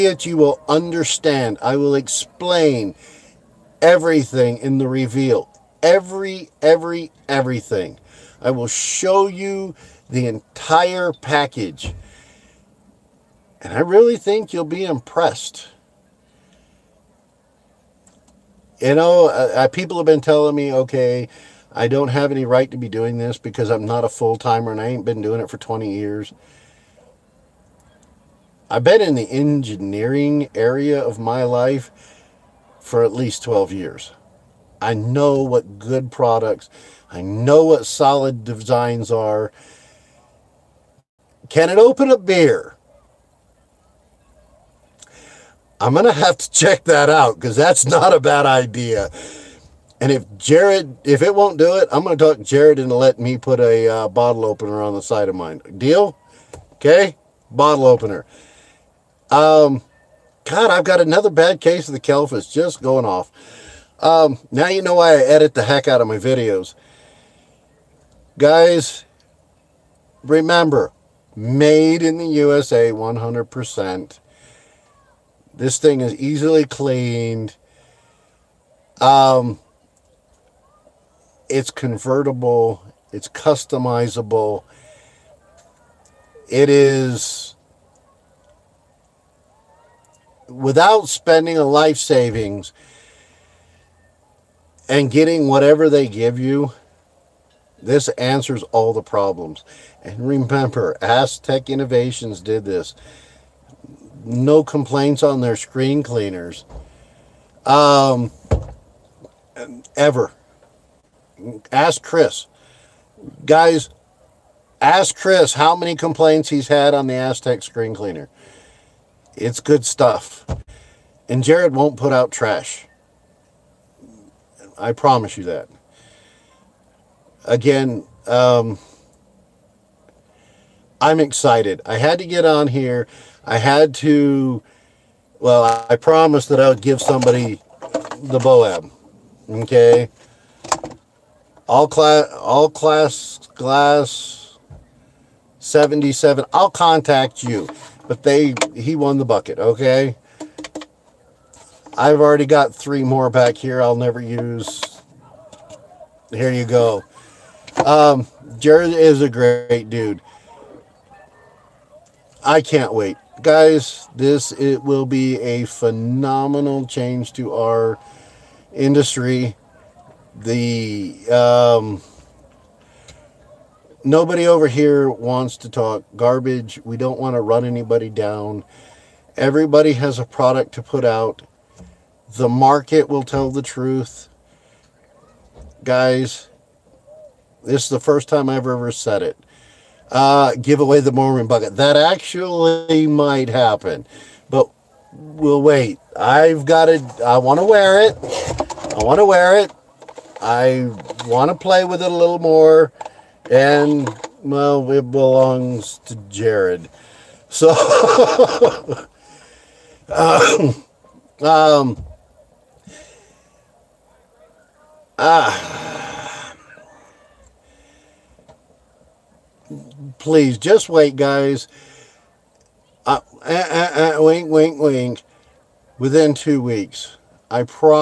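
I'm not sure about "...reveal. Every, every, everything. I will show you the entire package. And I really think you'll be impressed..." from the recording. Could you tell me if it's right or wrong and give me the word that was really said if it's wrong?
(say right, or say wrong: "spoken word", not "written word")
right.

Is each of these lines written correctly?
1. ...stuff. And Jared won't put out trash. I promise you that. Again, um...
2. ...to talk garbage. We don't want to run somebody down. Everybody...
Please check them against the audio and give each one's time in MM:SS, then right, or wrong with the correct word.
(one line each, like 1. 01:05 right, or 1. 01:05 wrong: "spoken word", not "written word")
1. 01:59 right
2. 02:55 wrong: "anybody", not "somebody".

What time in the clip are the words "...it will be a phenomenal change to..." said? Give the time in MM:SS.
02:44.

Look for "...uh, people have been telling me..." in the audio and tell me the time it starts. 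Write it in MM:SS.
00:19.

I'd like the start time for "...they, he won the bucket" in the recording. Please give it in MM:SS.
02:28.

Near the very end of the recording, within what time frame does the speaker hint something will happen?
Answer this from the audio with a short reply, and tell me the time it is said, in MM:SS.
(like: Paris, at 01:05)
2 weeks, at 03:46.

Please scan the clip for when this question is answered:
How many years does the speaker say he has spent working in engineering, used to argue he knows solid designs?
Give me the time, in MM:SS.
00:33.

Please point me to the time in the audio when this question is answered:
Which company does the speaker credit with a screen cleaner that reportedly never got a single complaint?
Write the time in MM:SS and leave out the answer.
01:41.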